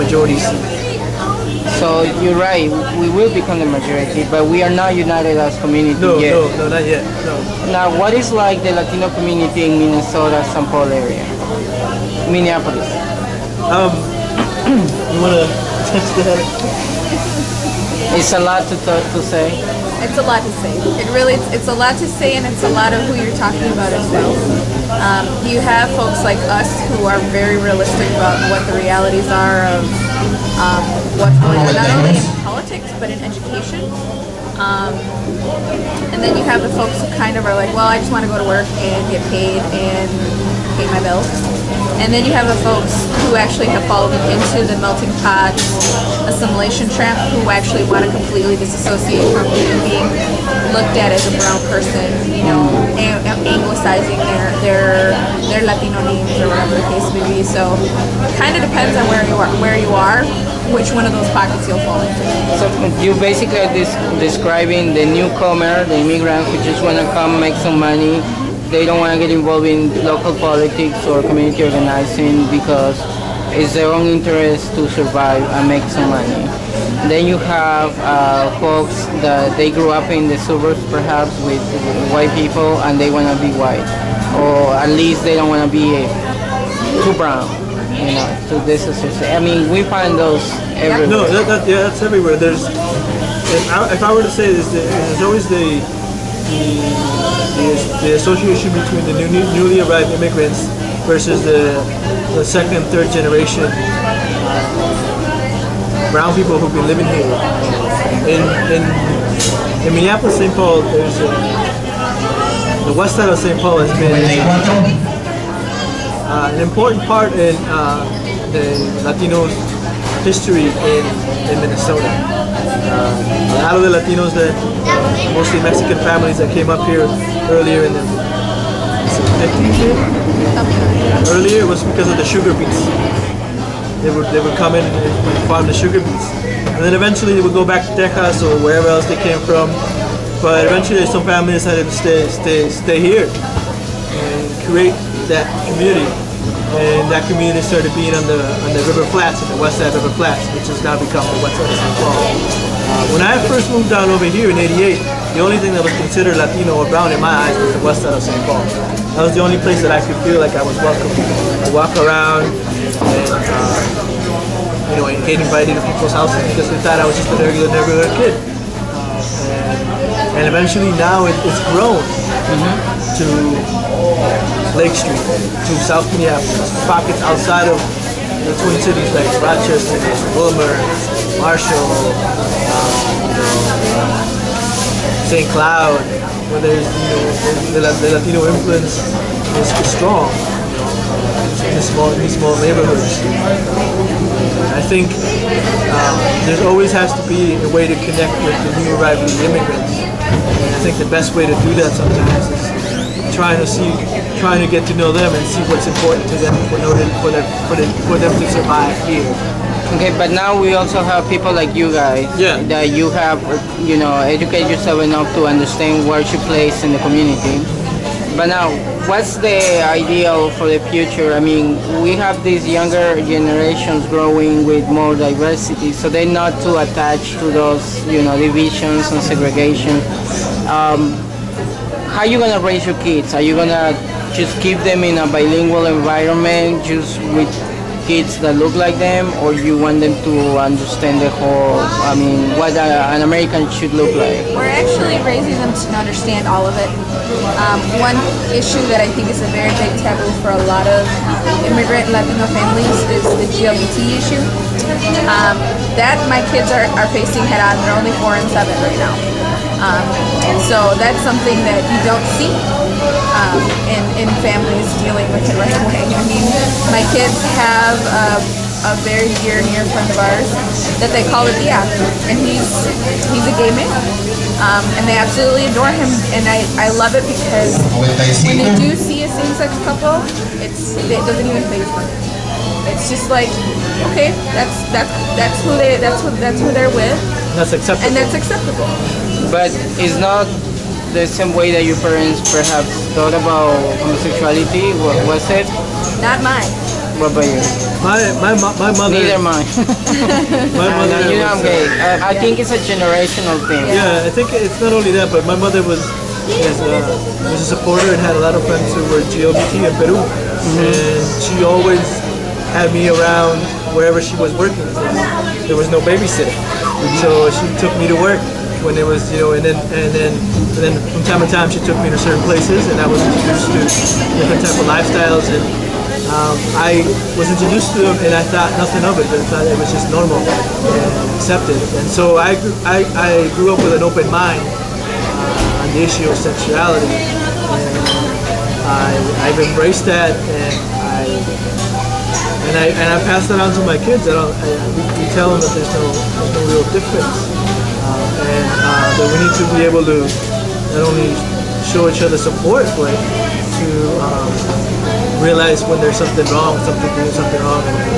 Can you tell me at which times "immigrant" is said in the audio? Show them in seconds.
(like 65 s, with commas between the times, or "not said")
66 s, 100 s, 199 s, 251 s.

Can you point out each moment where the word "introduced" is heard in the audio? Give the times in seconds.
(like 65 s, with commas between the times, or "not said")
323 s, 327 s.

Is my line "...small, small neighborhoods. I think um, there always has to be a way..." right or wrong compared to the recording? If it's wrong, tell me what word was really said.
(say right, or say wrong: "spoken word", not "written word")
right.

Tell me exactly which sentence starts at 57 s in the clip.
So kind of depends on where you are where you are which one of those pockets you'll fall into.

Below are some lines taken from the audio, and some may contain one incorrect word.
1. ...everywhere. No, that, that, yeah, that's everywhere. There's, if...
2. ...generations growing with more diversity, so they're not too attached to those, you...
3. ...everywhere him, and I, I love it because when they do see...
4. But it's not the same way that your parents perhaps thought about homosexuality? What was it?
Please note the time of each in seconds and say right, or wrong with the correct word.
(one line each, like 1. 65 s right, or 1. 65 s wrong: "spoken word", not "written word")
1. 90 s right
2. 223 s right
3. 275 s wrong: "adore", not "everywhere"
4. 289 s right.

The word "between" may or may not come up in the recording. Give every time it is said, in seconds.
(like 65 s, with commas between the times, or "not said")
98 s.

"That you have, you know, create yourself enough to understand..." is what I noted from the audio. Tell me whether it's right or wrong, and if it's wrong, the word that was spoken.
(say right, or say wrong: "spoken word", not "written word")
wrong: "educate", not "create".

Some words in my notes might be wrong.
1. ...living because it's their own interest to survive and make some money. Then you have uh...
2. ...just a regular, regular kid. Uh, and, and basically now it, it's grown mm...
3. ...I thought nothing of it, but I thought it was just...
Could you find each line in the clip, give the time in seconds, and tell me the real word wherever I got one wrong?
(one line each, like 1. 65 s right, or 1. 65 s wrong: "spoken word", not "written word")
1. 71 s wrong: "organizing", not "living"
2. 167 s wrong: "eventually", not "basically"
3. 328 s right.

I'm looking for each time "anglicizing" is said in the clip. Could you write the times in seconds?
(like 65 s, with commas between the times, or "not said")
53 s.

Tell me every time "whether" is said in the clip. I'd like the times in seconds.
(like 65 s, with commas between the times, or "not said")
not said.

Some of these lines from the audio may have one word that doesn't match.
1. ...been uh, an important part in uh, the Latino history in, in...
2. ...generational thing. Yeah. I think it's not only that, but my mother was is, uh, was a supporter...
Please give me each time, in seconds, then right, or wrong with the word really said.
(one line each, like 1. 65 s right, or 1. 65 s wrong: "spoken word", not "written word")
1. 113 s right
2. 302 s right.